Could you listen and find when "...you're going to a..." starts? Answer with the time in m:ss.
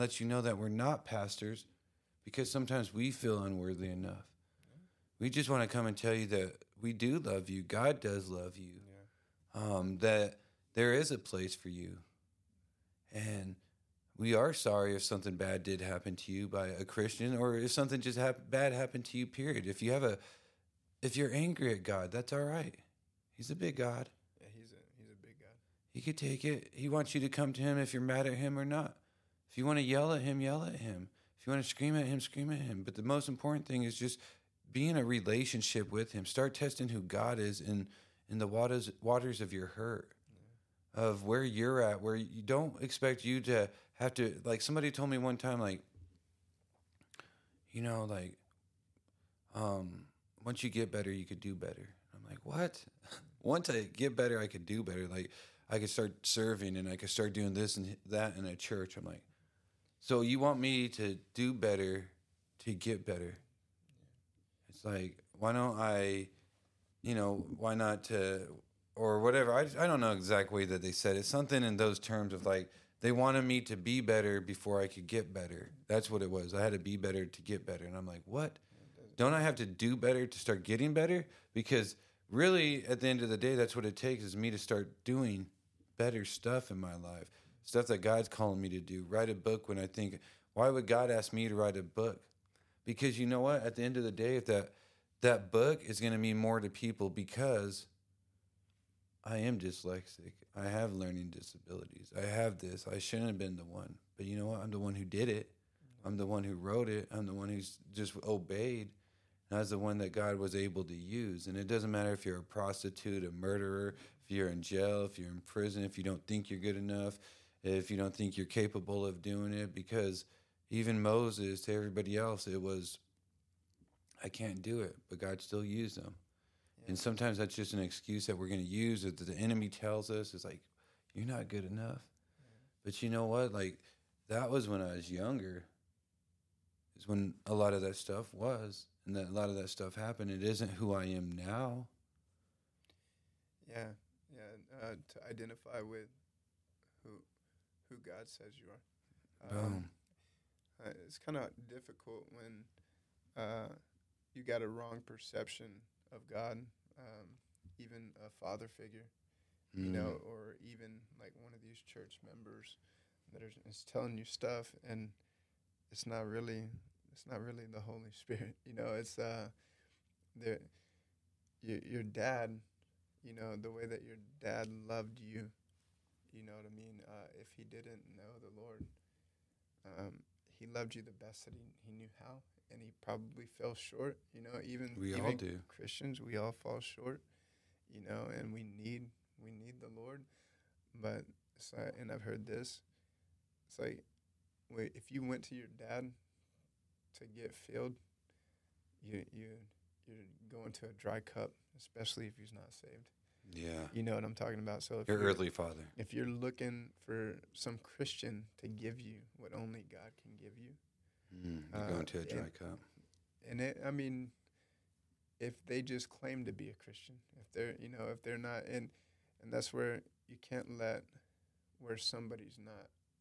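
3:20.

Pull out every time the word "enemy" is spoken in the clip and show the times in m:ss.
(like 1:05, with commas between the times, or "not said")
2:09.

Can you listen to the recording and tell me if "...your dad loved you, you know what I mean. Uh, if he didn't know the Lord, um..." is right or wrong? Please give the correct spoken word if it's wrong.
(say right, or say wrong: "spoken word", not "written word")
right.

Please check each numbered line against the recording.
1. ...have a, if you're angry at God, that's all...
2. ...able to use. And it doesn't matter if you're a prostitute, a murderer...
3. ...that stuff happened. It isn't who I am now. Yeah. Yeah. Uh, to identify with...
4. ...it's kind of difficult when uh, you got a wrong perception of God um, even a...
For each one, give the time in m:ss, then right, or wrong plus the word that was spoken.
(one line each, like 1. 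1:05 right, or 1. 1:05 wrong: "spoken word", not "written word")
1. 0:19 right
2. 1:50 right
3. 2:19 right
4. 2:31 right.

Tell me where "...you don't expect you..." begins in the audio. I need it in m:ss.
0:42.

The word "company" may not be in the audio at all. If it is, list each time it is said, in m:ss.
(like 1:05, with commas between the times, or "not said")
not said.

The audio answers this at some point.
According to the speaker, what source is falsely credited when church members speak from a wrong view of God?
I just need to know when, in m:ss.
2:47.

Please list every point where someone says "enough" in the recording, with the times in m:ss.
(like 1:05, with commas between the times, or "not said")
0:03, 1:56, 2:11.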